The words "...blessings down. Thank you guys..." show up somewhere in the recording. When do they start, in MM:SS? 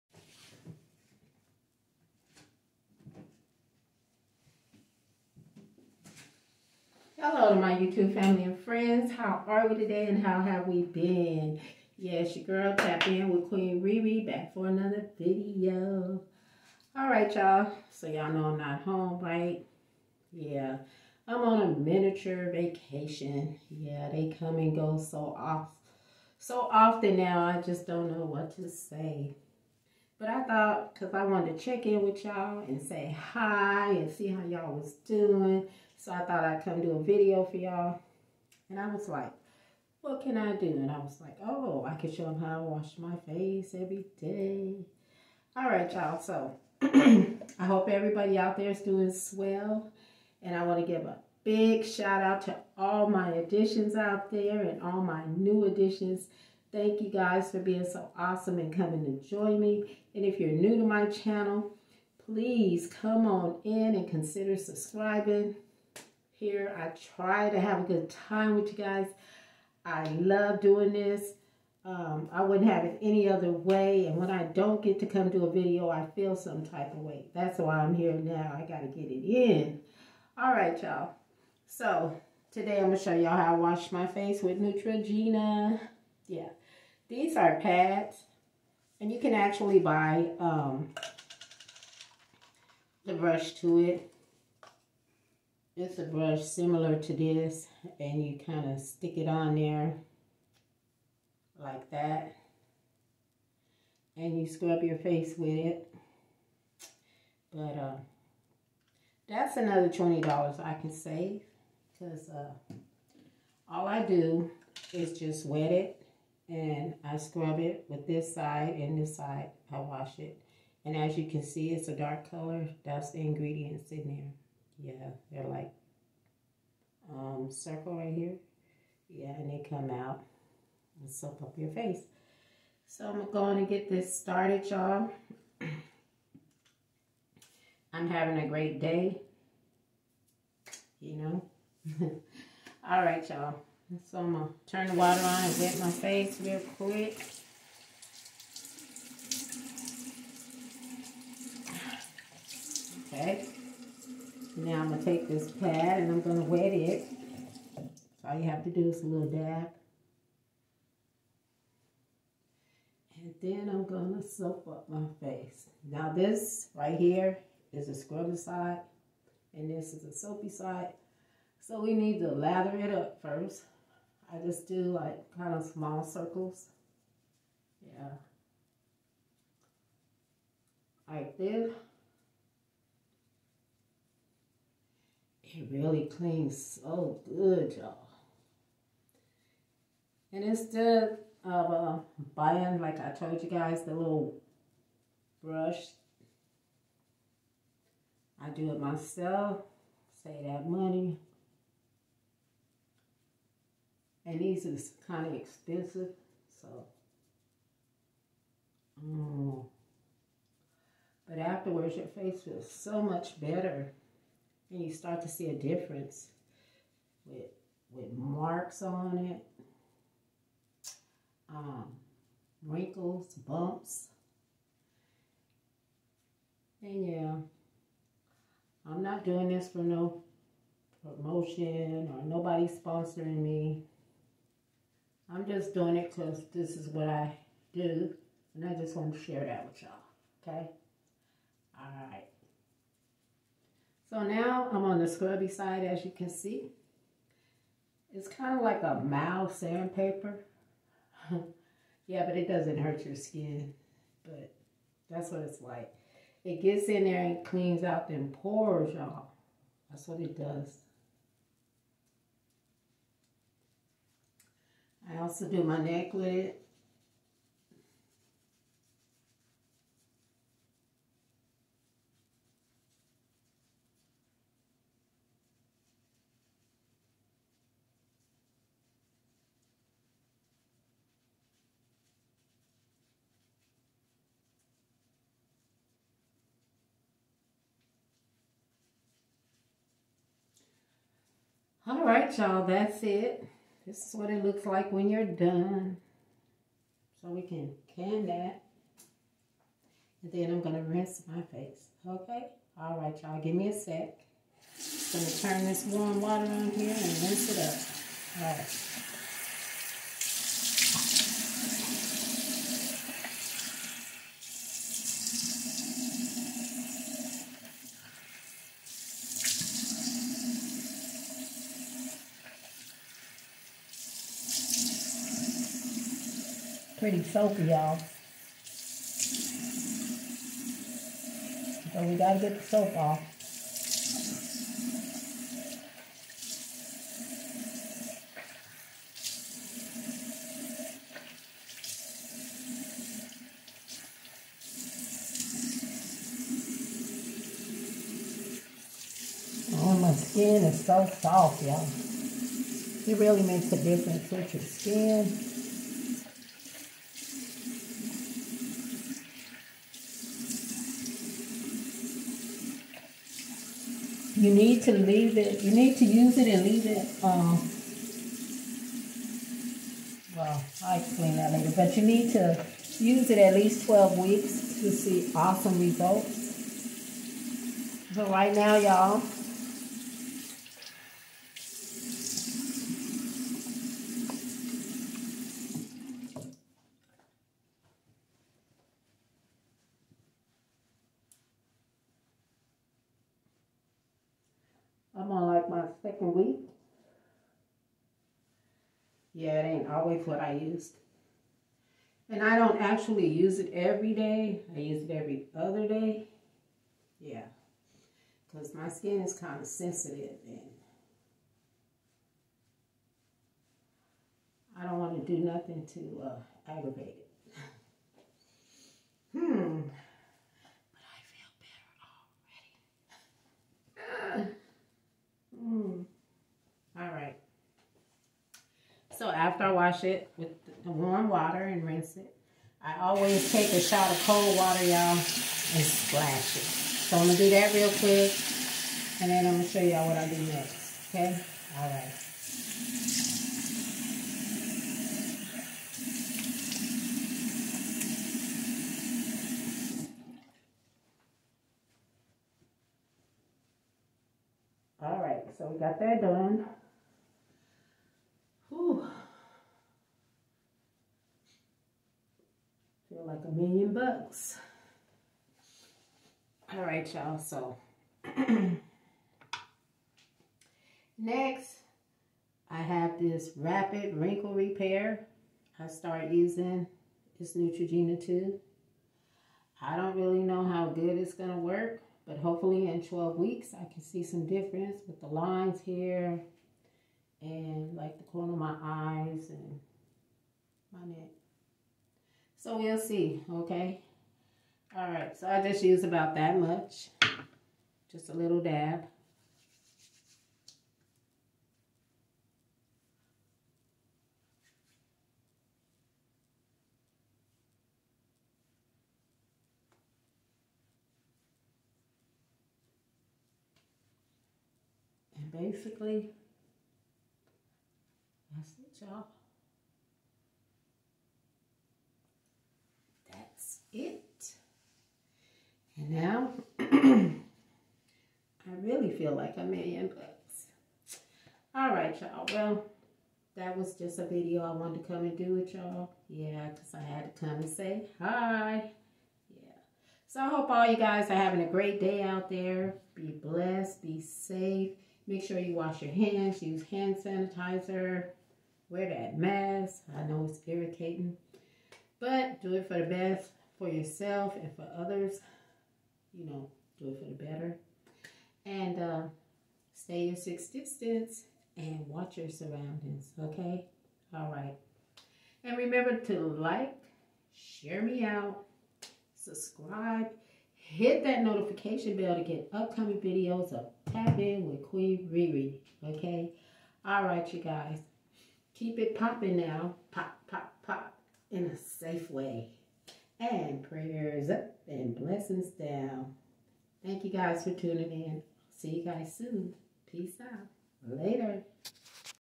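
09:45.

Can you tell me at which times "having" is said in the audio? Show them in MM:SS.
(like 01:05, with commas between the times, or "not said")
02:18, 09:01.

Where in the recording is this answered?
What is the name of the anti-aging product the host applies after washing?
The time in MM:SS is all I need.
07:53.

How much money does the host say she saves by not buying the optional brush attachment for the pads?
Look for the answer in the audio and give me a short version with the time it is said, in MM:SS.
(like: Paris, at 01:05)
$20, at 01:49.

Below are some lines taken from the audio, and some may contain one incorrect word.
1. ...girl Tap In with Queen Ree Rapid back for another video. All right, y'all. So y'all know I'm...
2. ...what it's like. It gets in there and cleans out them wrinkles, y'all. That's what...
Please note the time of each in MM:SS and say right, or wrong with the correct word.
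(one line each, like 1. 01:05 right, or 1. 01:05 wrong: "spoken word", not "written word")
1. 00:12 wrong: "Ree", not "Rapid"
2. 04:15 wrong: "pores", not "wrinkles".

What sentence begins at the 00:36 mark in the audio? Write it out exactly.
So I thought I'd come do a video for y'all.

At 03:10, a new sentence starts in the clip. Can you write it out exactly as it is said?
And instead of uh, buying, like I told you guys, the little brush, I do it myself, save that money.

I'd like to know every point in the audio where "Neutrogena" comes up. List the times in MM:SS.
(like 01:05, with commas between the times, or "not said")
01:24, 07:57.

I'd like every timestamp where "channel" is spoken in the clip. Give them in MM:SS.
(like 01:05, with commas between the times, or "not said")
01:01.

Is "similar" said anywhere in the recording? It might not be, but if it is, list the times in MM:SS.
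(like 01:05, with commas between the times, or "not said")
01:36.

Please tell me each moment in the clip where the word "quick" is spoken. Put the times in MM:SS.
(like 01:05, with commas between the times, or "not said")
02:26, 07:17.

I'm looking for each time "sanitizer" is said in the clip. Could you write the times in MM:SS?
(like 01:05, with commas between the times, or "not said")
09:07.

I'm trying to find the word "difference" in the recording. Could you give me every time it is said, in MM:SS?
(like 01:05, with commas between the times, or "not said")
03:35, 05:53, 08:04.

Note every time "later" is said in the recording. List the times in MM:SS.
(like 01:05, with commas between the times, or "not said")
06:11, 09:51.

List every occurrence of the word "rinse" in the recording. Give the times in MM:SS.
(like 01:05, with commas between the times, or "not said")
05:00, 05:07, 07:11.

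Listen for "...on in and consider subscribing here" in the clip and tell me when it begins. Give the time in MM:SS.
01:03.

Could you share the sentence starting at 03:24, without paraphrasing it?
And these is kind of expensive, so.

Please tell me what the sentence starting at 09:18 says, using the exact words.
And uh, stay your six distance and watch your surroundings, okay?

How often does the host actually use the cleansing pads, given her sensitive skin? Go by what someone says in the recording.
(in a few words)
every other day.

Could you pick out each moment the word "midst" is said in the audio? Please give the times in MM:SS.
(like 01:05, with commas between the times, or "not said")
not said.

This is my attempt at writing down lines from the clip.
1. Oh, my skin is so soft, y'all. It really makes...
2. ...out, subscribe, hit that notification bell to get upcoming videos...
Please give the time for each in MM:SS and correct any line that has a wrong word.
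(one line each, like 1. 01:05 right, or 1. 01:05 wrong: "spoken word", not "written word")
1. 05:49 right
2. 09:28 right.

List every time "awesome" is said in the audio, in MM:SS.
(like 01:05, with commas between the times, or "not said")
00:58, 06:15.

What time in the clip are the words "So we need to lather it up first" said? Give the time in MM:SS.
02:51.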